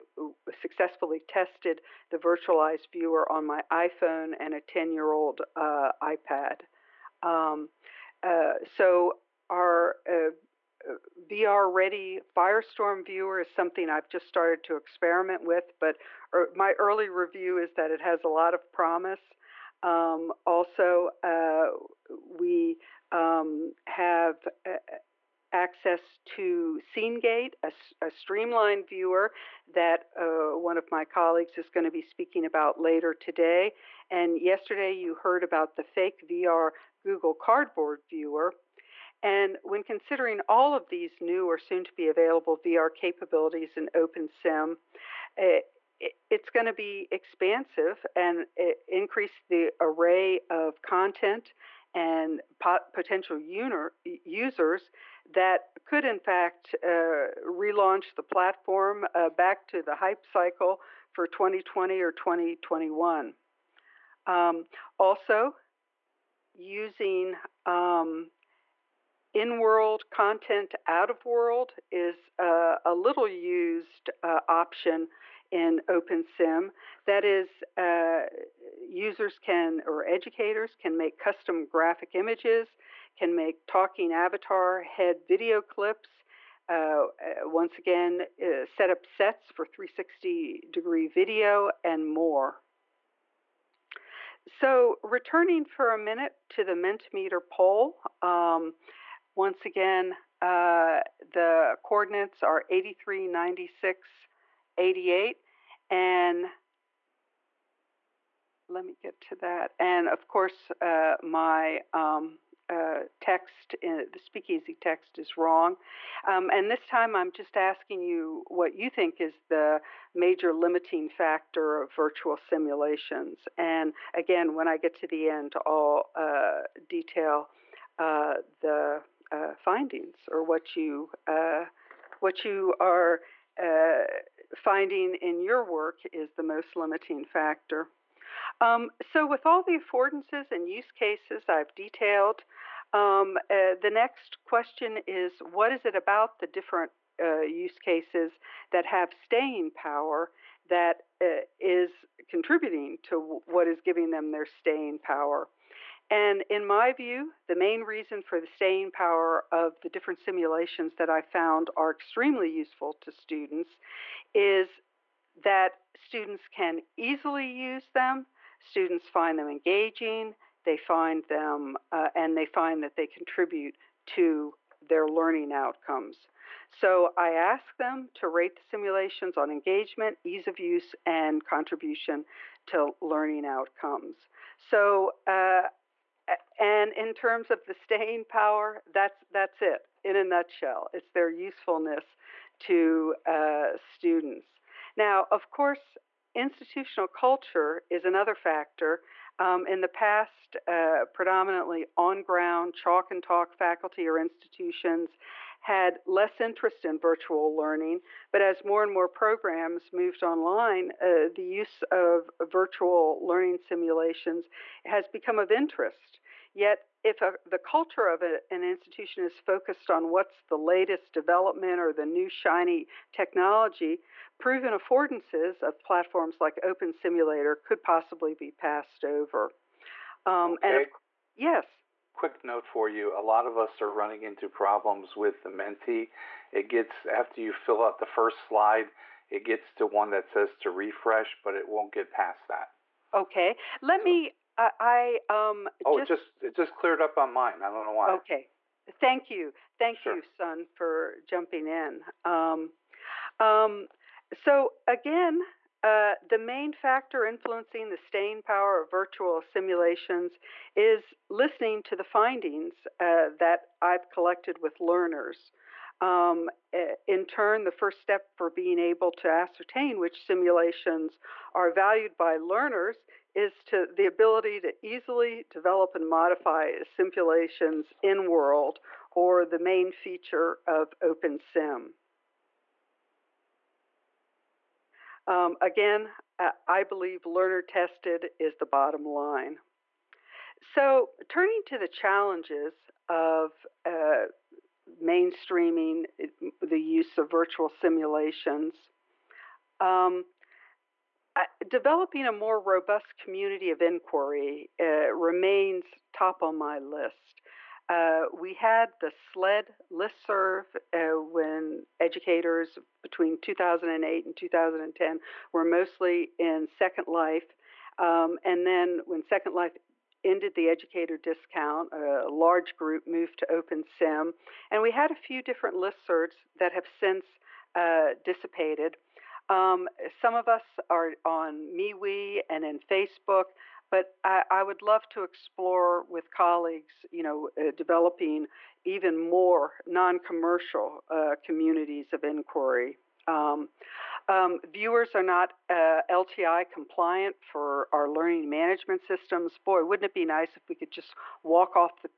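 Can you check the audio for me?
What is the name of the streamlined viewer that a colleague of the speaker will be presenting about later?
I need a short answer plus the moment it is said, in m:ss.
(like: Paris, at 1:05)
SceneGate, at 0:26.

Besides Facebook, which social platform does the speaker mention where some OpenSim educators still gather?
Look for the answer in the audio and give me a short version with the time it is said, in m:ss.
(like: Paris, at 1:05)
MeWe, at 5:31.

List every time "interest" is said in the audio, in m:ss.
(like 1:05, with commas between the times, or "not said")
3:26, 3:35.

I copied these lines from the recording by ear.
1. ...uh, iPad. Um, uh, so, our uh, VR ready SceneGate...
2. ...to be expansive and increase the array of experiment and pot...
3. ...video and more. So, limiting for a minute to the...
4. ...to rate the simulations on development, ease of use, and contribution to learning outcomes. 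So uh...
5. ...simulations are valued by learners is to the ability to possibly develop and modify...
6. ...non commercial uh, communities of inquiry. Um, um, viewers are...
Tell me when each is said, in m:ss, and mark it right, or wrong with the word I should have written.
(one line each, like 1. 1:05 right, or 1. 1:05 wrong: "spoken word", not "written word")
1. 0:05 wrong: "Firestorm", not "SceneGate"
2. 0:46 wrong: "content", not "experiment"
3. 1:31 wrong: "returning", not "limiting"
4. 2:58 wrong: "engagement", not "development"
5. 4:30 wrong: "easily", not "possibly"
6. 5:39 right.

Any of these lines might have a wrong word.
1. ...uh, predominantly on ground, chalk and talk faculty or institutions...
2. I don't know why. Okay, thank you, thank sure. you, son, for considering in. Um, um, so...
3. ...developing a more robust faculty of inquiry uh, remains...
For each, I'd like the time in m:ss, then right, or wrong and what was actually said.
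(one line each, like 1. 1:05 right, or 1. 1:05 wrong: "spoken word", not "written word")
1. 3:20 right
2. 4:07 wrong: "jumping", not "considering"
3. 5:01 wrong: "community", not "faculty".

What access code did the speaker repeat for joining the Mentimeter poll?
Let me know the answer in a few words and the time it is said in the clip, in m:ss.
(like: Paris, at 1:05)
83 96 88, at 1:42.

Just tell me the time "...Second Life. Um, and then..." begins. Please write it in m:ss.
5:16.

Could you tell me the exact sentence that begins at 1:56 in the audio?
Um, and this time I'm just asking you what you think is the major limiting factor of virtual simulations.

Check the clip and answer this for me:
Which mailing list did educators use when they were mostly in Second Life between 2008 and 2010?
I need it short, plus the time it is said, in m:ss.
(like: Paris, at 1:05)
SLED listserv, at 5:09.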